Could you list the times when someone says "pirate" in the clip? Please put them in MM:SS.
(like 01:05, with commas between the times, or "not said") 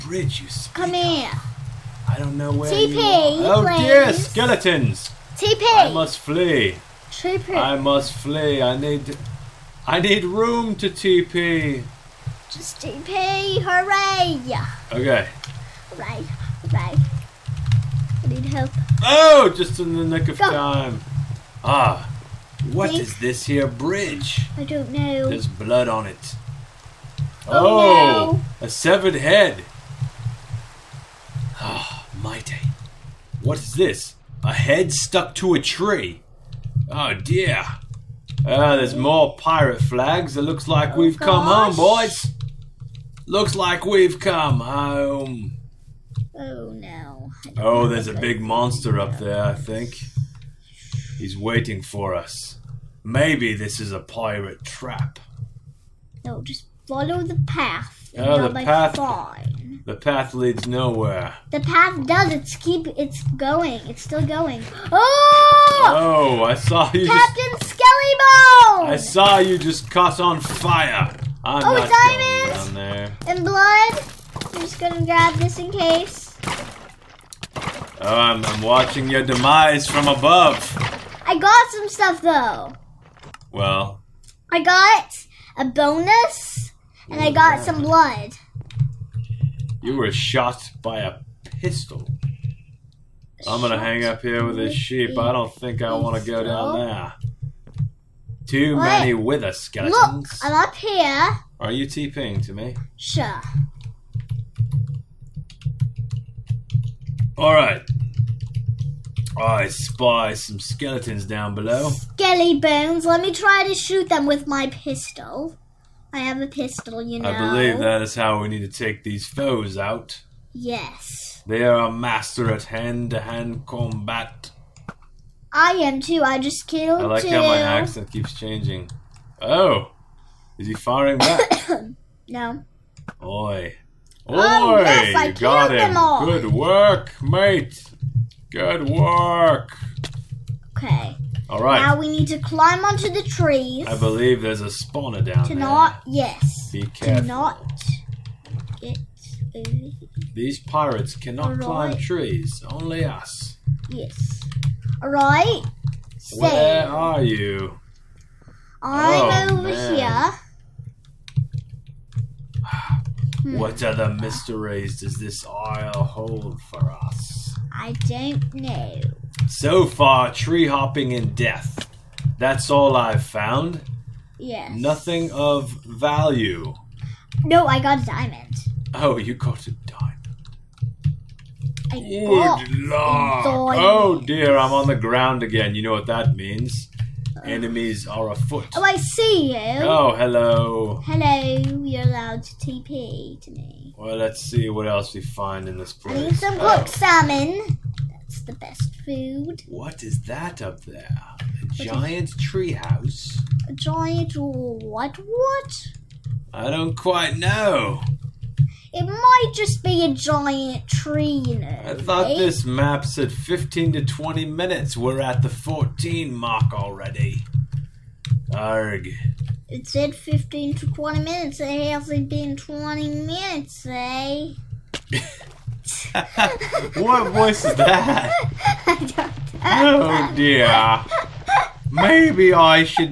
00:39, 00:53, 02:30.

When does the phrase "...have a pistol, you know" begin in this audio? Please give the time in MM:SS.
01:56.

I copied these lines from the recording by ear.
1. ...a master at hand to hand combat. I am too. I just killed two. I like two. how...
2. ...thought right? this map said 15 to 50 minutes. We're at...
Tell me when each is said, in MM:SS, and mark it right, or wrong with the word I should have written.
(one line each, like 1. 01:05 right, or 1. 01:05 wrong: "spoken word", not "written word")
1. 02:01 right
2. 03:31 wrong: "20", not "50".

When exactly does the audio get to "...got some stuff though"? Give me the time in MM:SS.
01:21.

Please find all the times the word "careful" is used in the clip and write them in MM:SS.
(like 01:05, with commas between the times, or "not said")
02:26.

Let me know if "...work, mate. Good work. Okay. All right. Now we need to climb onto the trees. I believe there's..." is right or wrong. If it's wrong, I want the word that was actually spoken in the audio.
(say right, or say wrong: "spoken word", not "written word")
right.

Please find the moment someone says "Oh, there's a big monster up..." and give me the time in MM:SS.
00:47.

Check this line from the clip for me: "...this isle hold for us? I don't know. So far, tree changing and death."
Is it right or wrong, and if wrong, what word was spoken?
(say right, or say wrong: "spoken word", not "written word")
wrong: "hopping", not "changing".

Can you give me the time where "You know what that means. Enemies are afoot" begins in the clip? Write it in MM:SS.
03:05.